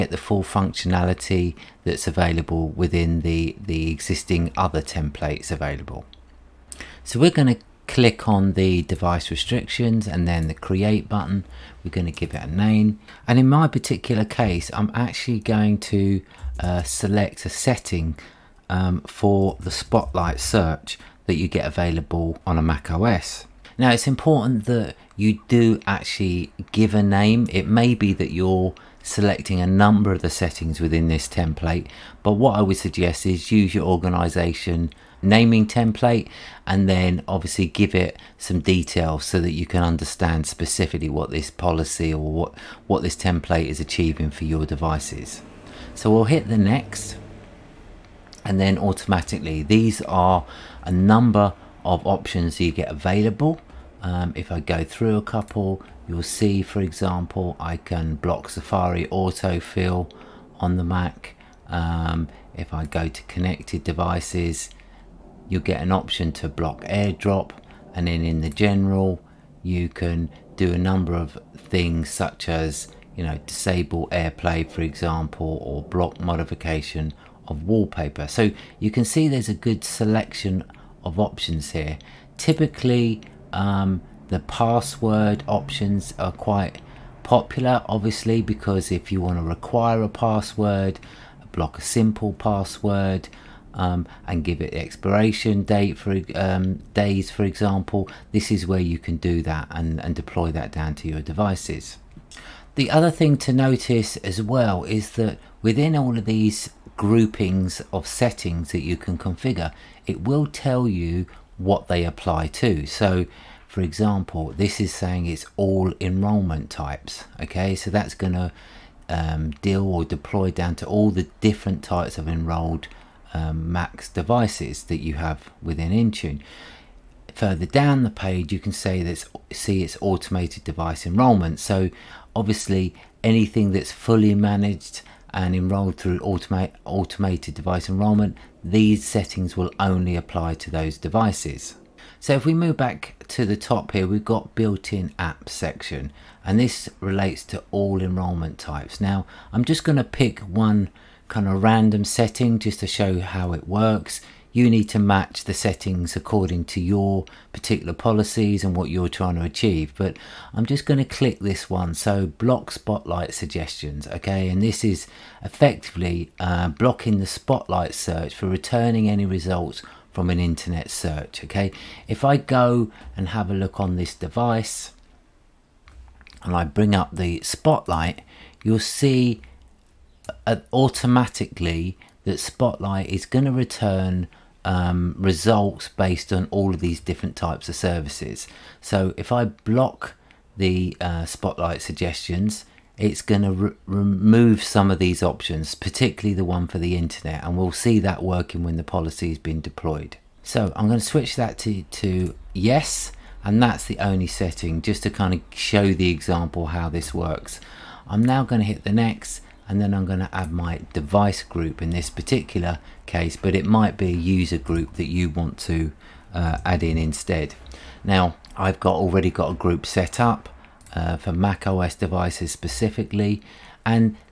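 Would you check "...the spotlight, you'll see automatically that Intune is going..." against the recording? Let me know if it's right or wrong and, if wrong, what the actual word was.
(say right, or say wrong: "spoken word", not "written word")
wrong: "Spotlight", not "Intune".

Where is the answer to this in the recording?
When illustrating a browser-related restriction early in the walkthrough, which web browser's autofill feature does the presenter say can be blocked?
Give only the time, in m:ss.
0:58.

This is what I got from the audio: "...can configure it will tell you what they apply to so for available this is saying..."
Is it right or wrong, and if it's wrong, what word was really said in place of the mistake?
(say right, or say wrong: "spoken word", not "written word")
wrong: "example", not "available".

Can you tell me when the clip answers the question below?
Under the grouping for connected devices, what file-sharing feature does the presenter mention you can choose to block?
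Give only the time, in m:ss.
1:06.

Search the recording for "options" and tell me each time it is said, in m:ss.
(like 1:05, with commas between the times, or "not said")
0:52, 1:05, 1:21, 1:25, 3:15.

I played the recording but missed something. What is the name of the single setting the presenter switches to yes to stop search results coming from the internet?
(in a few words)
Block Spotlight suggestions.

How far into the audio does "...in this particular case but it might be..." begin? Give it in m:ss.
3:31.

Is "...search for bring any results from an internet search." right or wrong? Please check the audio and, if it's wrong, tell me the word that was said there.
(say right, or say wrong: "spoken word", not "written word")
wrong: "returning", not "bring".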